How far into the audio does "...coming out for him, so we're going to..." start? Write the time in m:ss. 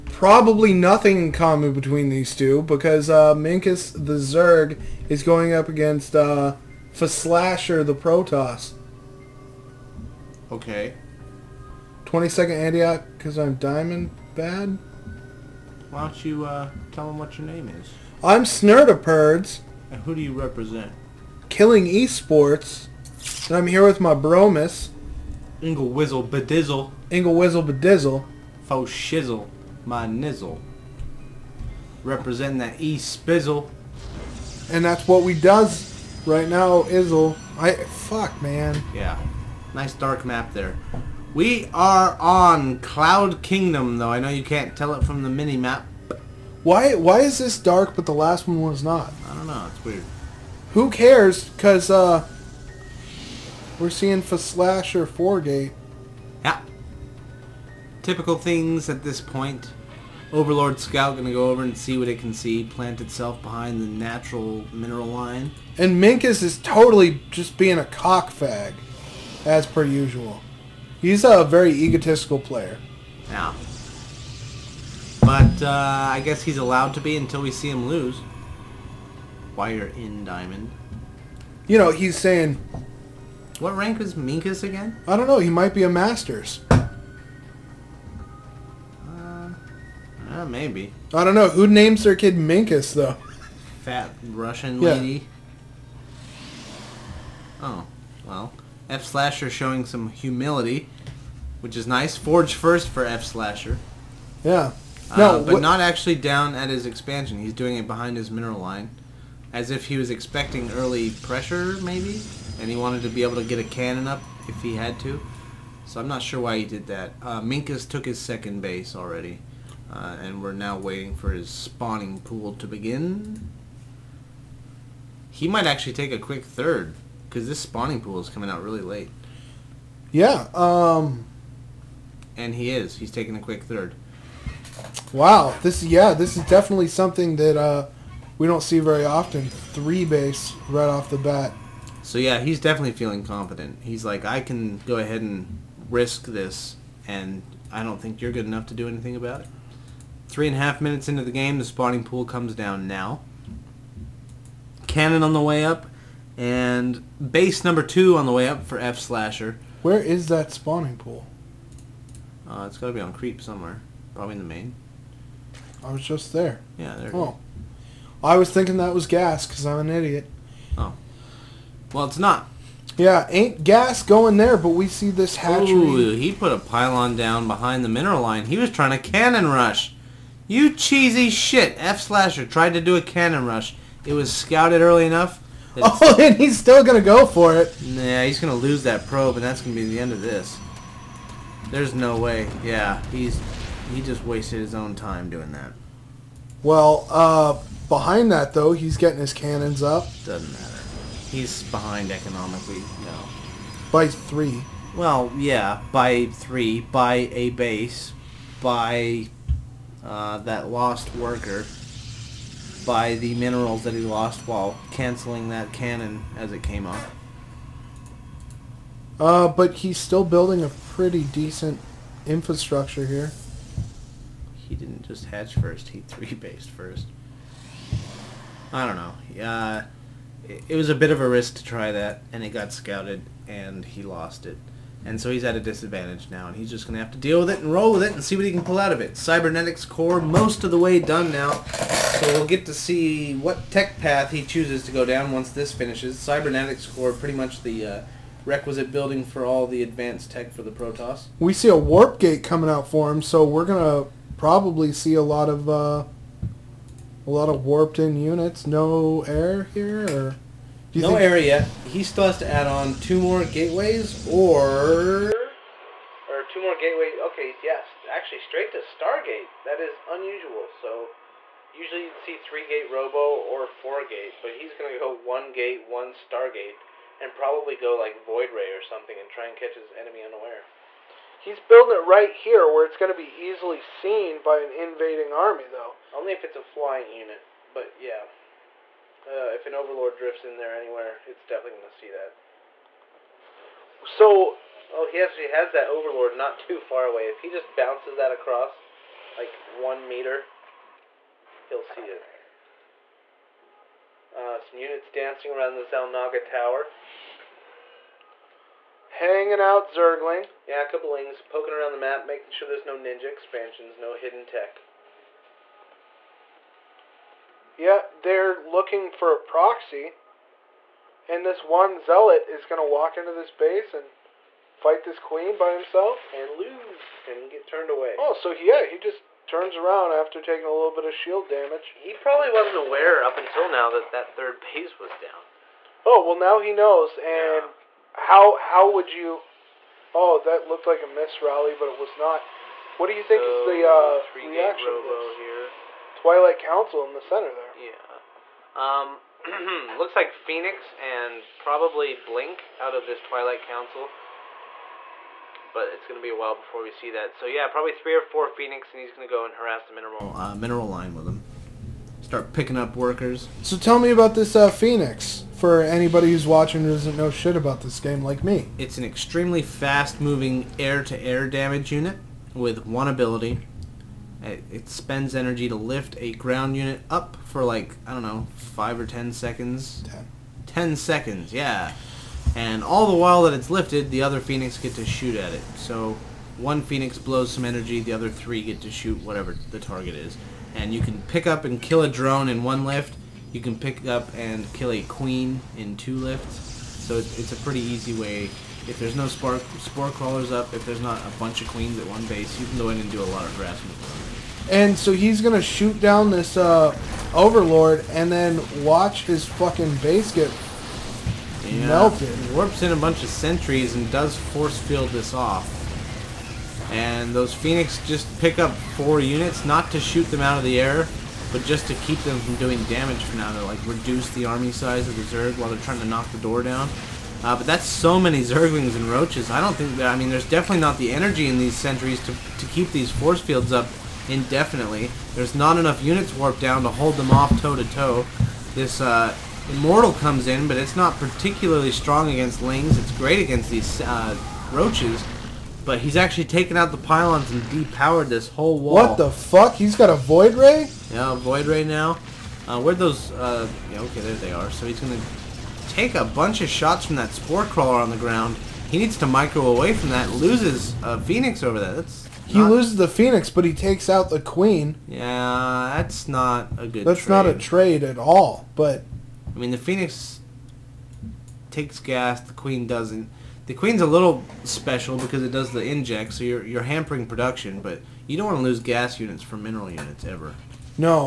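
4:12.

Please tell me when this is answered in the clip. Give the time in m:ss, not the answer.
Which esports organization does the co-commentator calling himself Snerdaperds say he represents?
0:21.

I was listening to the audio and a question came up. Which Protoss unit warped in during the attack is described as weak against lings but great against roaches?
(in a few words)
Immortal.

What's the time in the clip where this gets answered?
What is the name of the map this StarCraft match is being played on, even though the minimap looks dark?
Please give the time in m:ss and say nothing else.
0:42.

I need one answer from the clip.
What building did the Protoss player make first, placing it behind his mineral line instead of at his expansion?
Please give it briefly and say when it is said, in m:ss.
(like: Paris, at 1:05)
Forge, at 1:42.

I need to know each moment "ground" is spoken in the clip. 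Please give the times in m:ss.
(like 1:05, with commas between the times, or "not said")
6:16, 7:38.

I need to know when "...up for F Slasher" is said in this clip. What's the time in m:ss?
2:38.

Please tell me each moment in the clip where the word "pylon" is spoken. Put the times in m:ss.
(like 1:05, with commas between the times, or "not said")
2:56, 7:27.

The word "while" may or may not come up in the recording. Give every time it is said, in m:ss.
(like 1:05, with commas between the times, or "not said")
3:34, 5:56, 6:23, 7:05.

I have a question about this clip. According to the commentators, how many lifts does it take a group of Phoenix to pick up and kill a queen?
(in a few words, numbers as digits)
2.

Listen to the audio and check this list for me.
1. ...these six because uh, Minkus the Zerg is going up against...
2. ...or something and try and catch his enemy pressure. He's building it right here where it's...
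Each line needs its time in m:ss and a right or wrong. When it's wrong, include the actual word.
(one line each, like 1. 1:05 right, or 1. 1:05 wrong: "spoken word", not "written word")
1. 0:02 wrong: "two", not "six"
2. 4:38 wrong: "unaware", not "pressure".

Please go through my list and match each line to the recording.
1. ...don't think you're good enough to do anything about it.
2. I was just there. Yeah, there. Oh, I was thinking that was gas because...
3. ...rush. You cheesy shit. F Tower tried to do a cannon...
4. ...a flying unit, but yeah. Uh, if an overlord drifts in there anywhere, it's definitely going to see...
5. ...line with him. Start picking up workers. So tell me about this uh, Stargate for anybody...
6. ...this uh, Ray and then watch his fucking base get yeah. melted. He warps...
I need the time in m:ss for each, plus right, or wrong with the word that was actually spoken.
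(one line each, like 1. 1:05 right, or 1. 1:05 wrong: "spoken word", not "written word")
1. 2:27 right
2. 2:45 right
3. 2:59 wrong: "Slasher", not "Tower"
4. 4:46 right
5. 6:00 wrong: "Phoenix", not "Stargate"
6. 6:46 wrong: "Overlord", not "Ray".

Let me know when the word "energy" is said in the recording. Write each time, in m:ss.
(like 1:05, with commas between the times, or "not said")
6:15, 6:27, 7:11.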